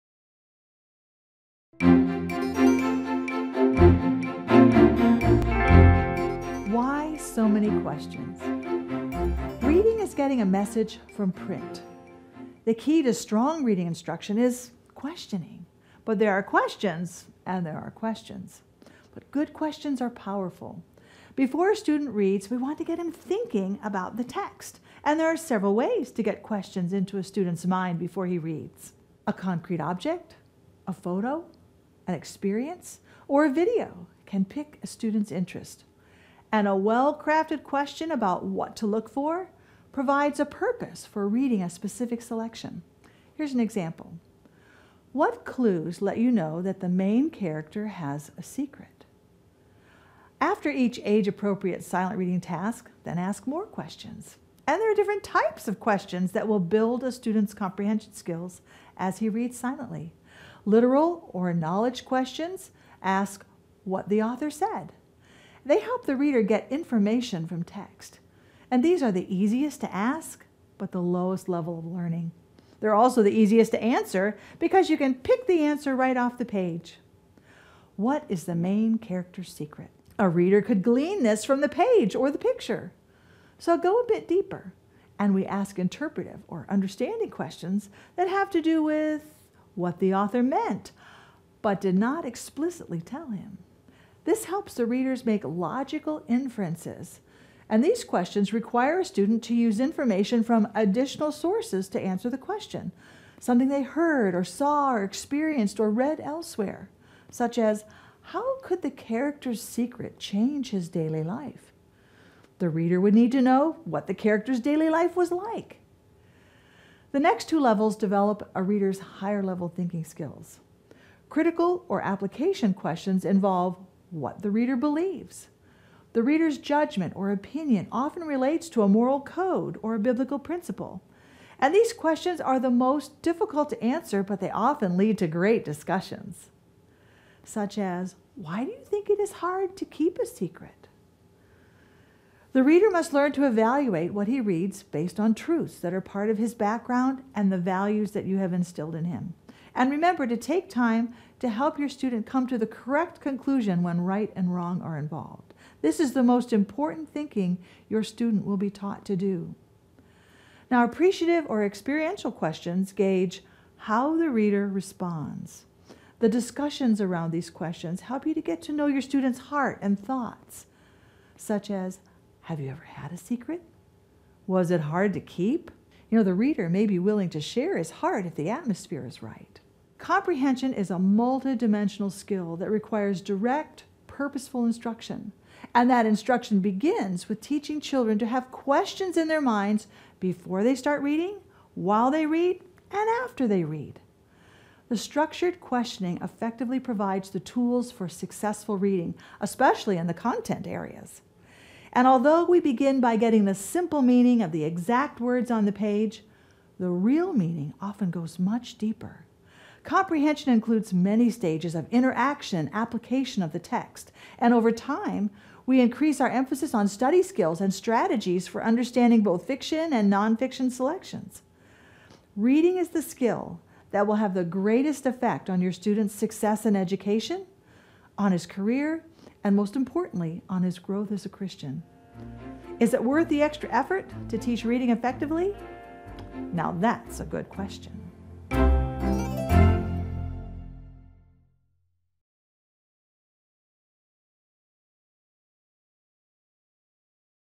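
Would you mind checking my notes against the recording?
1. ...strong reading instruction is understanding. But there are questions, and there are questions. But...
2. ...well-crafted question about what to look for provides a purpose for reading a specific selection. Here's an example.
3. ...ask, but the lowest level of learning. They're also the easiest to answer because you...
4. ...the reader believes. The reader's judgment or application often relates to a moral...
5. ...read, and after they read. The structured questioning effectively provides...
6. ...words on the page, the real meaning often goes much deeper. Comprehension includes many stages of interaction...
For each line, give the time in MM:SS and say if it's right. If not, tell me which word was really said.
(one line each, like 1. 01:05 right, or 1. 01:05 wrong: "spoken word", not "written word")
1. 00:13 wrong: "questioning", not "understanding"
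2. 00:36 right
3. 01:09 right
4. 02:04 wrong: "opinion", not "application"
5. 03:12 right
6. 03:25 right.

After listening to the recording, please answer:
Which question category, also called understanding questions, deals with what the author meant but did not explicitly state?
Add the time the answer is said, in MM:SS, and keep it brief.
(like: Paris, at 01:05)
Interpretive, at 01:25.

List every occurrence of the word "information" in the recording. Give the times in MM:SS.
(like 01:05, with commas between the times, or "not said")
01:06, 01:39.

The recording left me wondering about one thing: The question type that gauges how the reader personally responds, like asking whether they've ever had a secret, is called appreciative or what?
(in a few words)
Experiential.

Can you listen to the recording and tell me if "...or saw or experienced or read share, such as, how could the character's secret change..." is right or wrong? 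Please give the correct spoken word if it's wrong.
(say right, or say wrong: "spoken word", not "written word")
wrong: "elsewhere", not "share".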